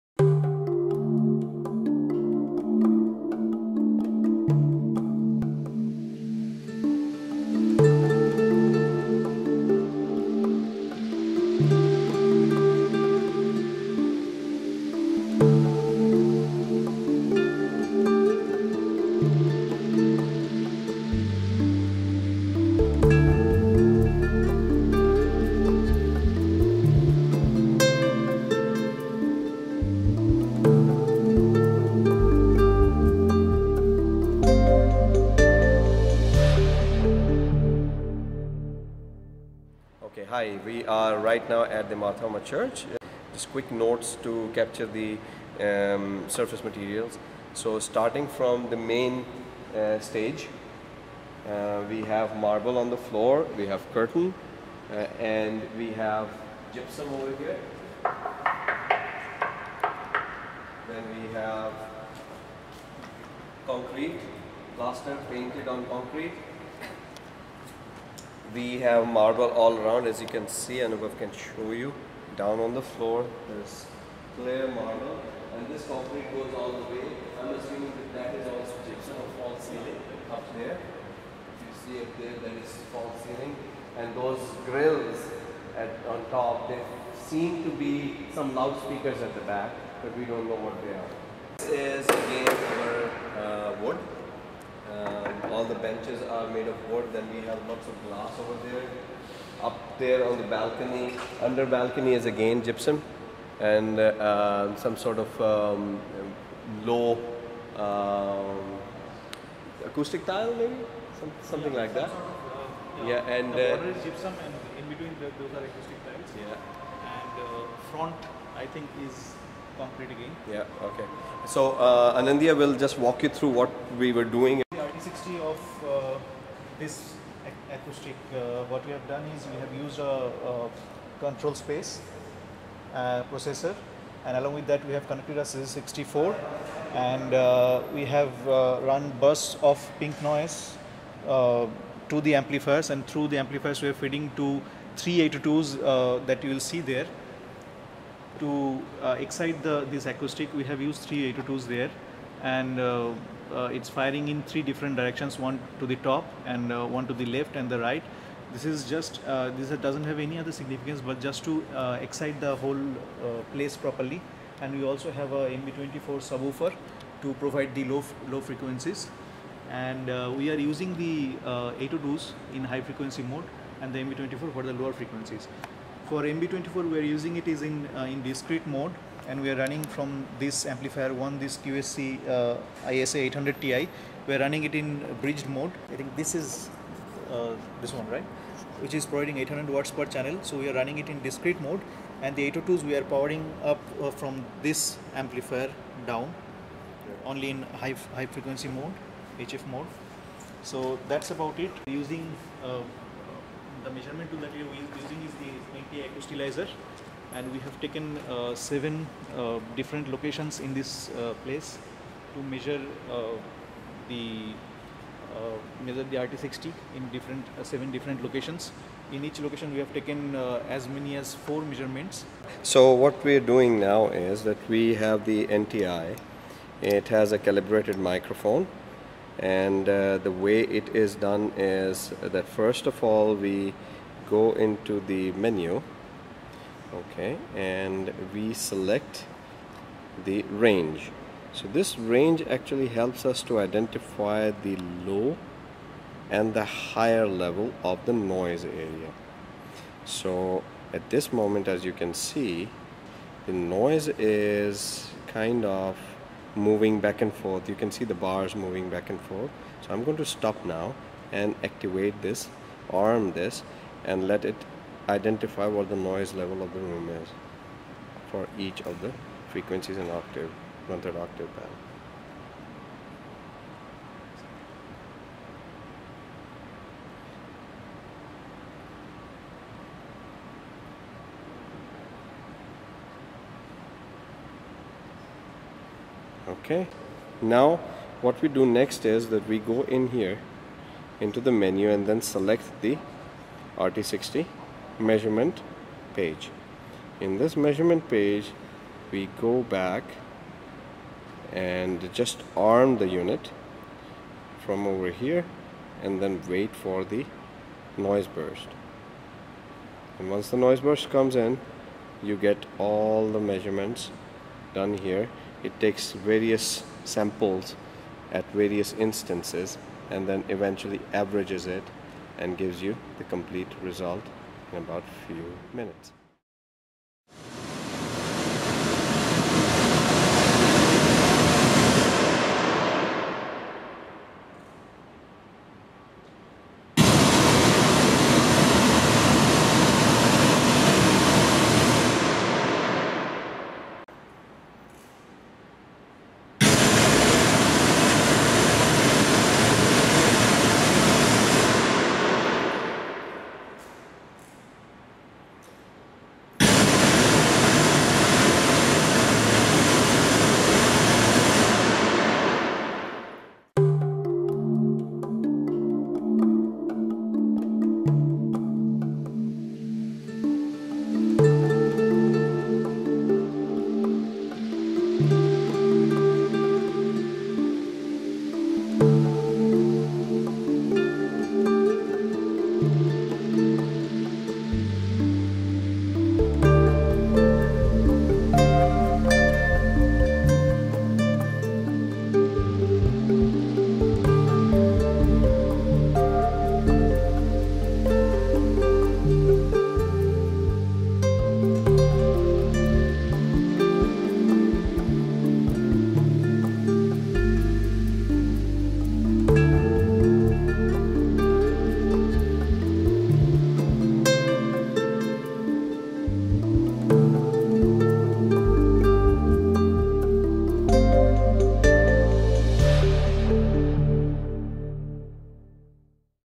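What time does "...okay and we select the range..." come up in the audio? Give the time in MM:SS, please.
03:56.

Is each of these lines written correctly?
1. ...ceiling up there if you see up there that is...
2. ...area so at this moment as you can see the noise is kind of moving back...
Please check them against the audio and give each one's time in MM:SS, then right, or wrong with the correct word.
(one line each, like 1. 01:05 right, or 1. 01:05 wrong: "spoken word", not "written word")
1. 01:19 right
2. 04:08 right.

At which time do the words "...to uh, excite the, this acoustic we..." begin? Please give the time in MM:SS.
02:28.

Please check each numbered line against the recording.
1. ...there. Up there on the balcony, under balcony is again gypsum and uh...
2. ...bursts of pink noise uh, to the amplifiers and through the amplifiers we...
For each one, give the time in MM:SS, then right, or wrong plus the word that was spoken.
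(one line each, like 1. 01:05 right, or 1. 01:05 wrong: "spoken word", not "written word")
1. 01:38 right
2. 02:19 right.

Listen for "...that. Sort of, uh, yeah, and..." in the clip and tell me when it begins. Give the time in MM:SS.
01:52.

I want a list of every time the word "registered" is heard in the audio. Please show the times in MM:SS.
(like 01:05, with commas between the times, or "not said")
not said.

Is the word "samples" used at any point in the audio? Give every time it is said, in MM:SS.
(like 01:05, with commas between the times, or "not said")
05:17.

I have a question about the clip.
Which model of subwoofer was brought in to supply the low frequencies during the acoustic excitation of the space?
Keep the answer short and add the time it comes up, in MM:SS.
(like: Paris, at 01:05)
MB24, at 02:45.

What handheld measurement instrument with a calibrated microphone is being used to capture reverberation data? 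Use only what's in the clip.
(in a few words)
NTI Acoustilyzer.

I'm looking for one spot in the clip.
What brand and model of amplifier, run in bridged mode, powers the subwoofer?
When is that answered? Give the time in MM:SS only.
03:01.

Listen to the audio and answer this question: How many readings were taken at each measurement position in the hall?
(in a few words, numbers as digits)
4.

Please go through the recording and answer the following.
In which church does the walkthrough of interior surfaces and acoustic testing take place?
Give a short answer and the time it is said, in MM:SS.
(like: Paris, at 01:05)
Mar Thoma Church, at 00:41.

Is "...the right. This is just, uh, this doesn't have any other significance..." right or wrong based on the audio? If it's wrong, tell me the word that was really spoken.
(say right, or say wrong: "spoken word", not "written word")
right.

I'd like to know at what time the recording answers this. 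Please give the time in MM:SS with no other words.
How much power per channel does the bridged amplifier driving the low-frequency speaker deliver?
03:09.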